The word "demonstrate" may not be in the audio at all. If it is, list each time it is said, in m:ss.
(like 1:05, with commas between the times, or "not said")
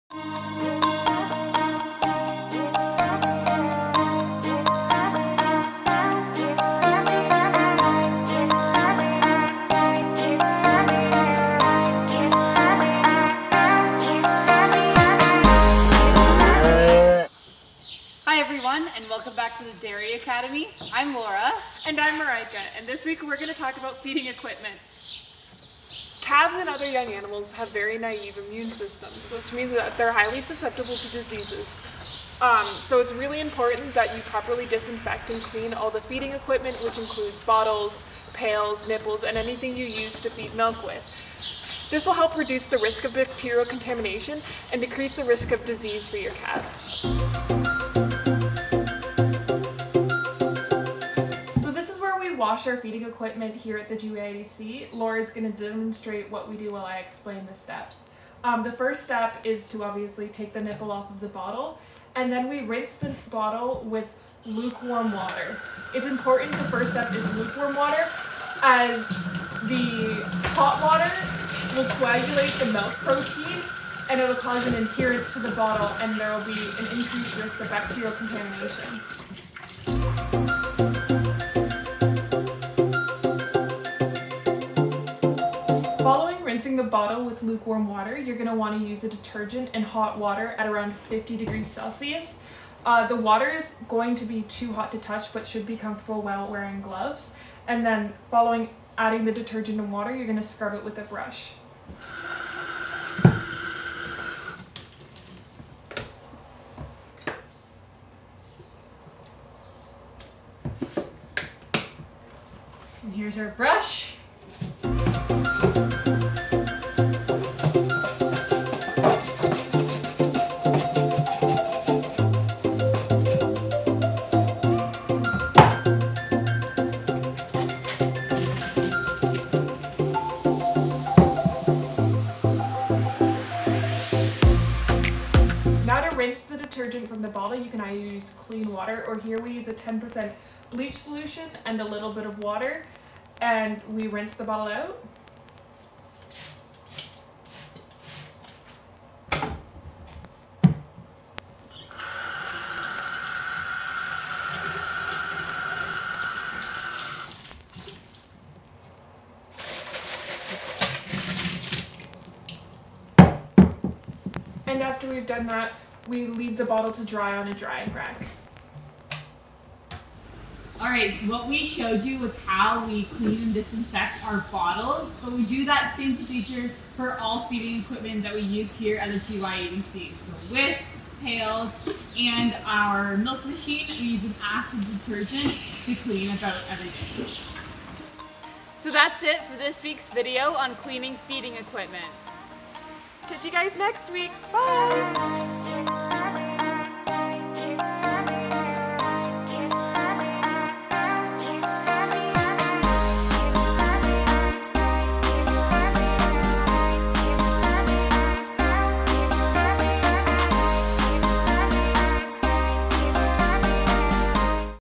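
0:55.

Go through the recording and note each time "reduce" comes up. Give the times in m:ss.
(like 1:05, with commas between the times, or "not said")
0:42.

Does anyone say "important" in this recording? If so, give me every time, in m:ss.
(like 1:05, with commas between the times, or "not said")
0:33, 1:06.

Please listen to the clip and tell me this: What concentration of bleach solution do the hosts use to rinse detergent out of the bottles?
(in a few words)
10%.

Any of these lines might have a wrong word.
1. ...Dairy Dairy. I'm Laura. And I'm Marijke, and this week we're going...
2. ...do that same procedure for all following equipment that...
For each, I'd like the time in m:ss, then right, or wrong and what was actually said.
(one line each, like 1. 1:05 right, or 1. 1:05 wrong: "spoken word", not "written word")
1. 0:19 wrong: "Academy", not "Dairy"
2. 2:55 wrong: "feeding", not "following".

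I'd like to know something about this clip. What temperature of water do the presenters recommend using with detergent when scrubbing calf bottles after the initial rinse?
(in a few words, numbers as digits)
50 degrees Celsius.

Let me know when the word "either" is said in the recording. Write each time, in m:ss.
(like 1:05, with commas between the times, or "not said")
2:17.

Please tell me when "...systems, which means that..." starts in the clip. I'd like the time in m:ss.
0:28.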